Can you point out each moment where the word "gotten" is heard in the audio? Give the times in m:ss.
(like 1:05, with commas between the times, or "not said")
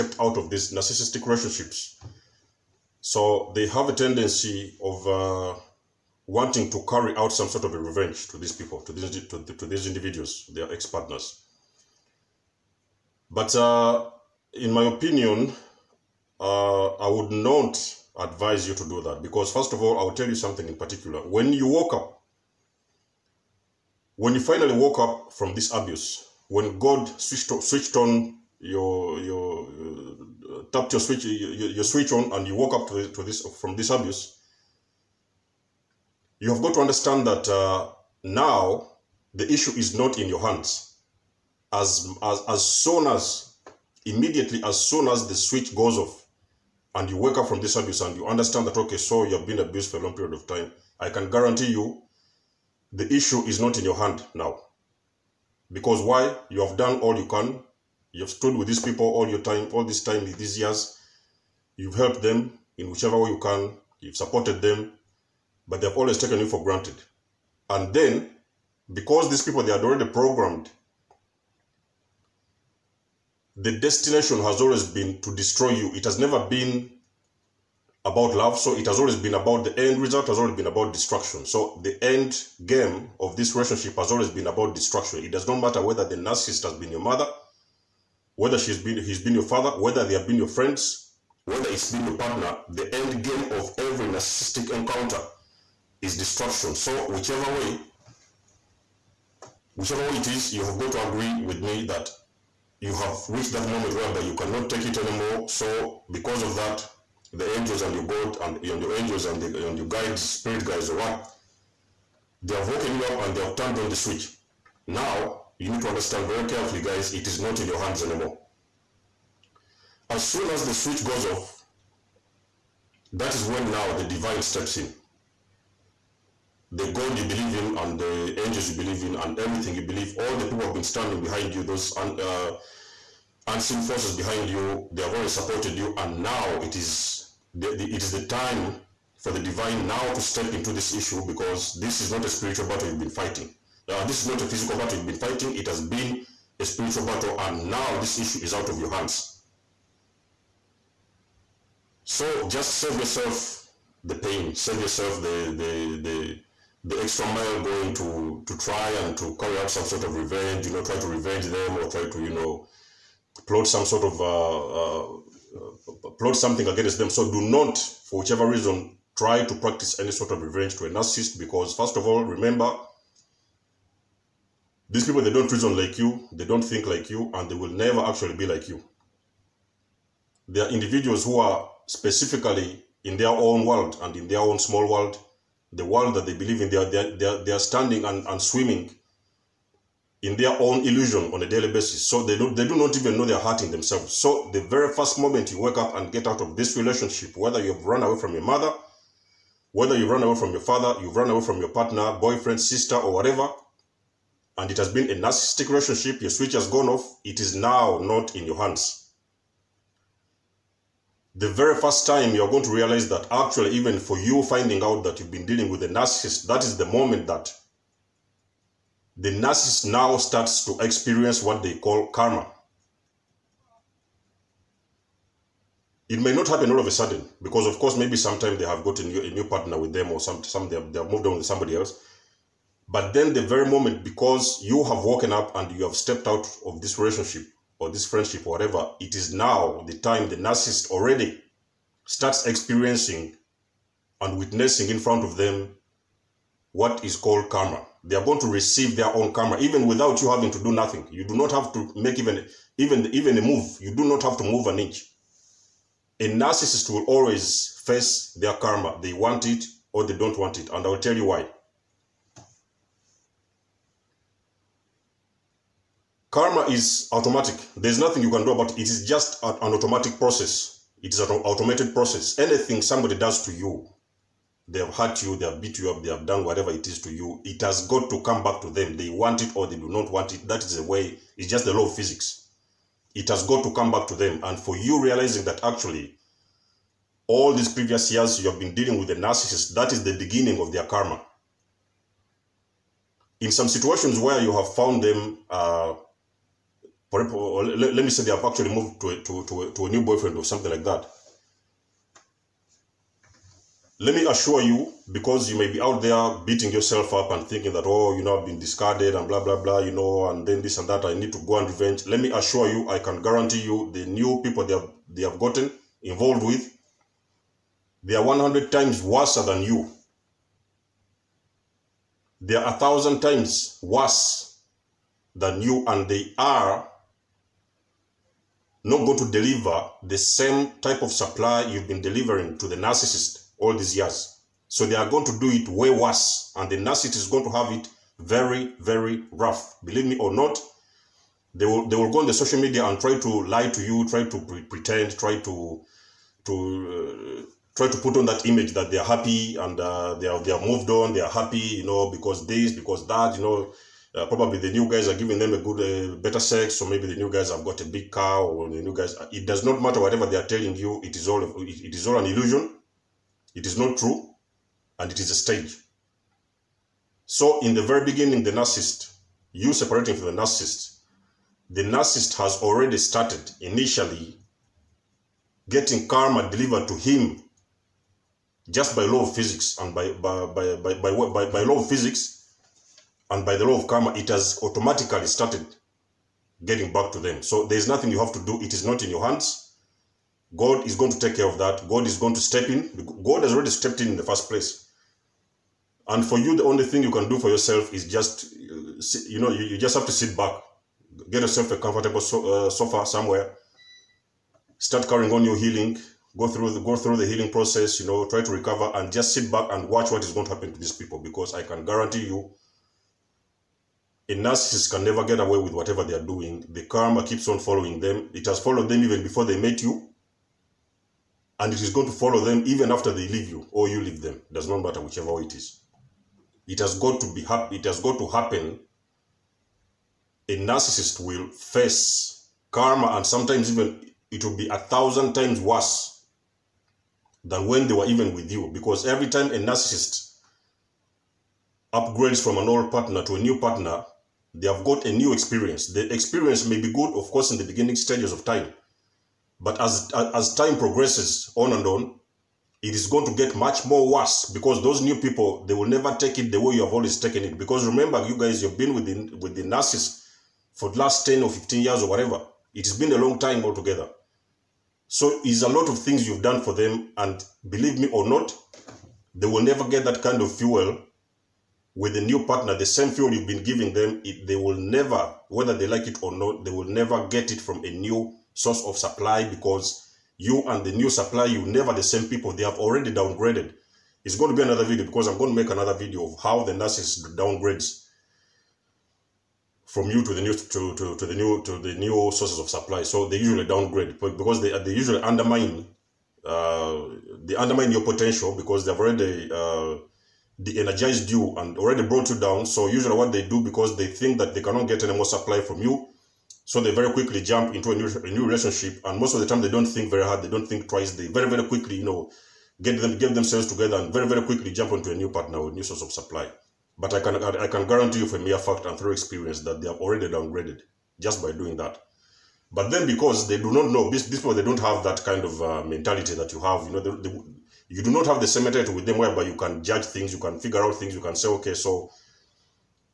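5:15.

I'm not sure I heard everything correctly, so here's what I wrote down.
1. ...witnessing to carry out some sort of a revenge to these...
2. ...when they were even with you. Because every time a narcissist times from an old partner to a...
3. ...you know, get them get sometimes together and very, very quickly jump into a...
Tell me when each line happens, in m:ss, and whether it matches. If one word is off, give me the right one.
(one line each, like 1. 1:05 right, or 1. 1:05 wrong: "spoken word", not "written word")
1. 0:06 wrong: "wanting", not "witnessing"
2. 7:17 wrong: "upgrades", not "times"
3. 8:31 wrong: "themselves", not "sometimes".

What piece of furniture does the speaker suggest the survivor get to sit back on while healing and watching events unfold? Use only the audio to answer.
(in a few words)
sofa.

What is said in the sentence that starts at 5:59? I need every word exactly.
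Uh, it does not matter whatever they are telling you.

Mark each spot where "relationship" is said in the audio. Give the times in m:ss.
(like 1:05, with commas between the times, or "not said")
0:01, 1:23, 3:16, 3:25, 3:56, 8:28.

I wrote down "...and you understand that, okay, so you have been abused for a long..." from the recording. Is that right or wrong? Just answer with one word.
right.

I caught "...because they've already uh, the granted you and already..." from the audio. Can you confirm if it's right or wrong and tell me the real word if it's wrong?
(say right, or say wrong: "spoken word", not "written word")
wrong: "energized", not "granted".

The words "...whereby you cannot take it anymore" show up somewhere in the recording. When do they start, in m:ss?
1:43.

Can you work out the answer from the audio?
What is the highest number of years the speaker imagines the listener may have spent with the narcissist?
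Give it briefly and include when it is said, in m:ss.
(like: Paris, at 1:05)
15, at 7:41.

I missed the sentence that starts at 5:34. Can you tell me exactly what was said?
So they are going to do it way worse, and the narcissist is going to have it very, very rough.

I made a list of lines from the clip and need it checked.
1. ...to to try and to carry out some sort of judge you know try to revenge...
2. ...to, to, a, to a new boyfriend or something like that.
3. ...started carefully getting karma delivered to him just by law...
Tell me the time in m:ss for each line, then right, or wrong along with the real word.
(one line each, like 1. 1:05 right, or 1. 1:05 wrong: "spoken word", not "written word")
1. 2:37 wrong: "revenge", not "judge"
2. 4:59 right
3. 6:12 wrong: "initially", not "carefully".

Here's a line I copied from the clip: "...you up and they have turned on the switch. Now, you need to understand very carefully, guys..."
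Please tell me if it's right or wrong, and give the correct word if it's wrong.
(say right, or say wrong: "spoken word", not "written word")
right.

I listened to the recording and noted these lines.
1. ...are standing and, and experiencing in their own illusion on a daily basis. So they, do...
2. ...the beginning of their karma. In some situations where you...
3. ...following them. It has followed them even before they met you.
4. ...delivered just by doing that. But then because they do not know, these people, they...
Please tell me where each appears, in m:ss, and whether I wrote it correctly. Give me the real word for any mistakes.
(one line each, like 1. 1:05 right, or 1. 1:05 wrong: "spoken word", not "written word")
1. 3:07 wrong: "swimming", not "experiencing"
2. 4:50 right
3. 6:57 right
4. 8:40 wrong: "downgraded", not "delivered".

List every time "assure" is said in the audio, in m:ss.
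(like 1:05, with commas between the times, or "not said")
5:04, 5:12.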